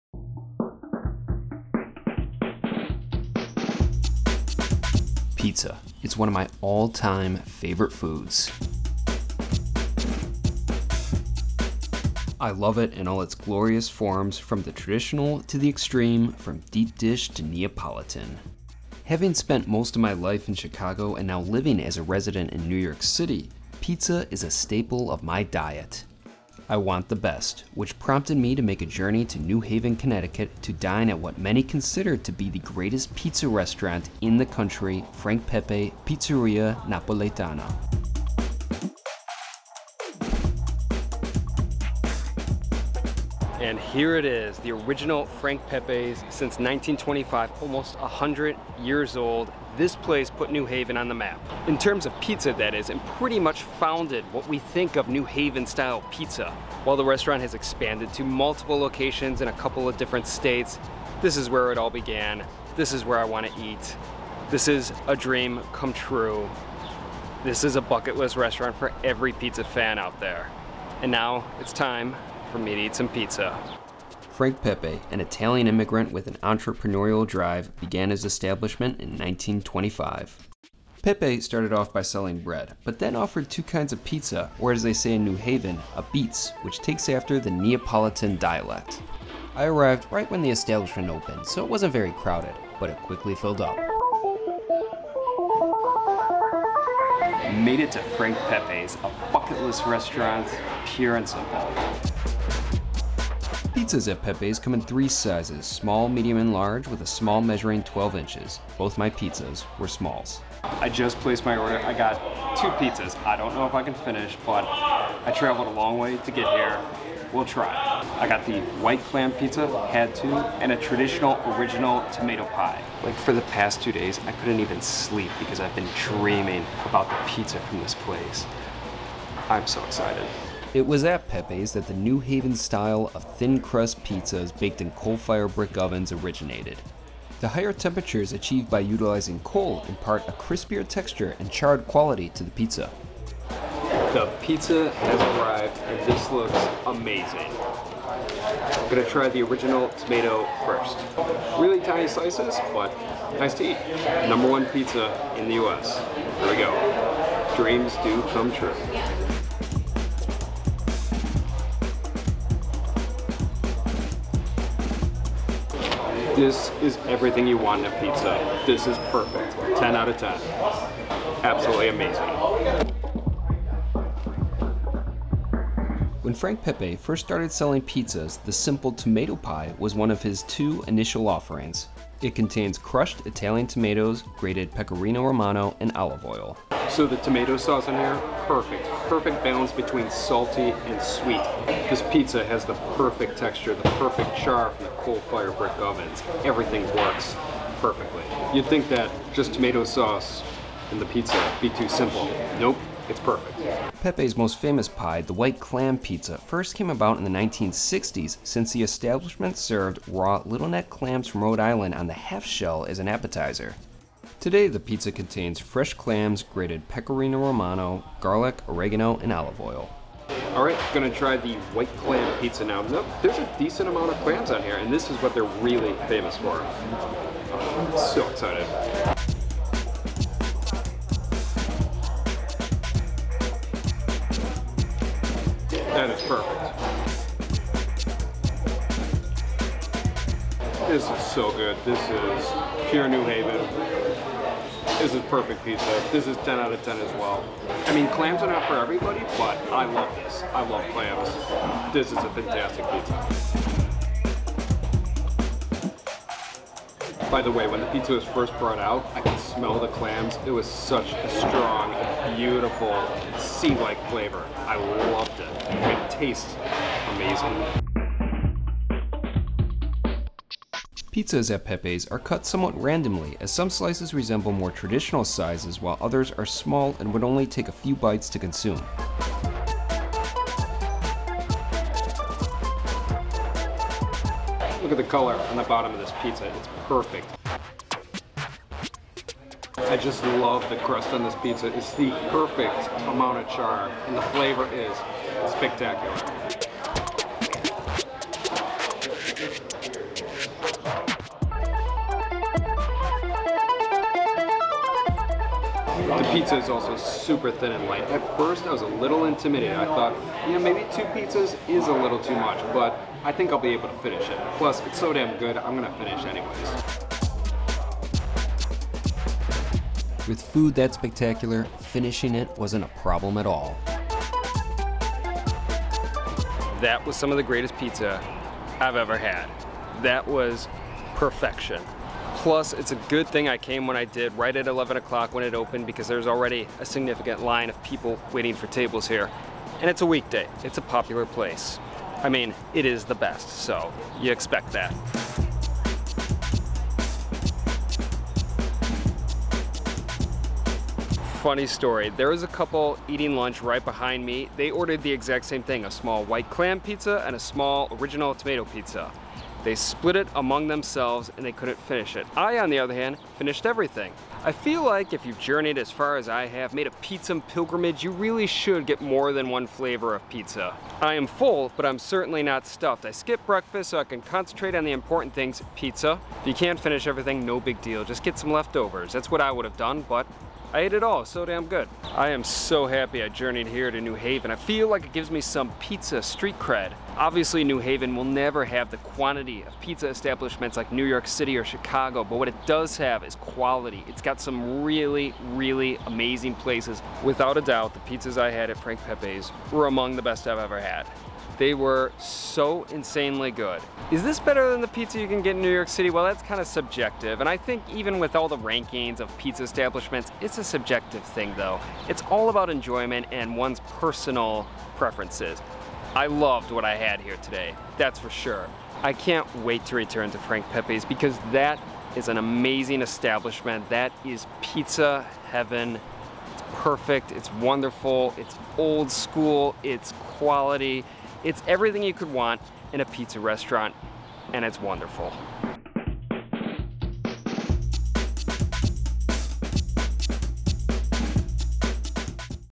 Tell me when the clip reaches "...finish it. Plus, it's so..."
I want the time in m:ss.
5:13.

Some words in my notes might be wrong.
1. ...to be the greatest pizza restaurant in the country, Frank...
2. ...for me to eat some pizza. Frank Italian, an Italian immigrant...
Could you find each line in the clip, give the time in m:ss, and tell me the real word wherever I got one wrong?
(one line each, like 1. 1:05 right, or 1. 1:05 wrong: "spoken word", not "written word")
1. 0:32 right
2. 1:12 wrong: "Pepe", not "Italian".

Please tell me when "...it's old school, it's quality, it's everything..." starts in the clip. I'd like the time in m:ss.
7:08.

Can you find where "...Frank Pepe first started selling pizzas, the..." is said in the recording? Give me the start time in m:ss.
2:56.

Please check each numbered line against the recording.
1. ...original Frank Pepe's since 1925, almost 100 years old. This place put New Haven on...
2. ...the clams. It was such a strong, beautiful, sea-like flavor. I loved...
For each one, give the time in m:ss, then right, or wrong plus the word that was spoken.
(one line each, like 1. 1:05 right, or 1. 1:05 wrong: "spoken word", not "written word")
1. 0:44 right
2. 4:19 right.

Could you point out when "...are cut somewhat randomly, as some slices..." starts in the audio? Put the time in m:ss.
4:32.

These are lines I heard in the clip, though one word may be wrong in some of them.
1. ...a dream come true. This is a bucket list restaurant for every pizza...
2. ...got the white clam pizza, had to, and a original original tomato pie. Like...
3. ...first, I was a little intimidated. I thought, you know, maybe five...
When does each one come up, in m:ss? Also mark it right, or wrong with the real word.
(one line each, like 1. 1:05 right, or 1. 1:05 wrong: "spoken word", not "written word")
1. 1:05 right
2. 1:58 wrong: "traditional", not "original"
3. 5:08 wrong: "two", not "five".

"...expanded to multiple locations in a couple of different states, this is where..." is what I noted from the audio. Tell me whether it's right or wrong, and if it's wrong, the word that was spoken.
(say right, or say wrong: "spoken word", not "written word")
right.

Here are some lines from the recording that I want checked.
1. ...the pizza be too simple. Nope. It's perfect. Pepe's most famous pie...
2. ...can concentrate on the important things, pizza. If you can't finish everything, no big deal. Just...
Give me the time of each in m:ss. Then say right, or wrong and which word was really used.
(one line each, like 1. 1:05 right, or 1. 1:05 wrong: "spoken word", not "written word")
1. 3:21 right
2. 6:14 right.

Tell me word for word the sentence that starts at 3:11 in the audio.
This pizza has the perfect texture, the perfect char from the coal fire brick ovens.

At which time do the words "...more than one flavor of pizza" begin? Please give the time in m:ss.
6:09.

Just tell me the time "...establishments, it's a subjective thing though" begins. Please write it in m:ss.
6:49.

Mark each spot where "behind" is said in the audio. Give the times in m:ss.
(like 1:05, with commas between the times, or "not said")
5:53.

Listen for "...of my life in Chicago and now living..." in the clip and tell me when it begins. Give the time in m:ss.
0:19.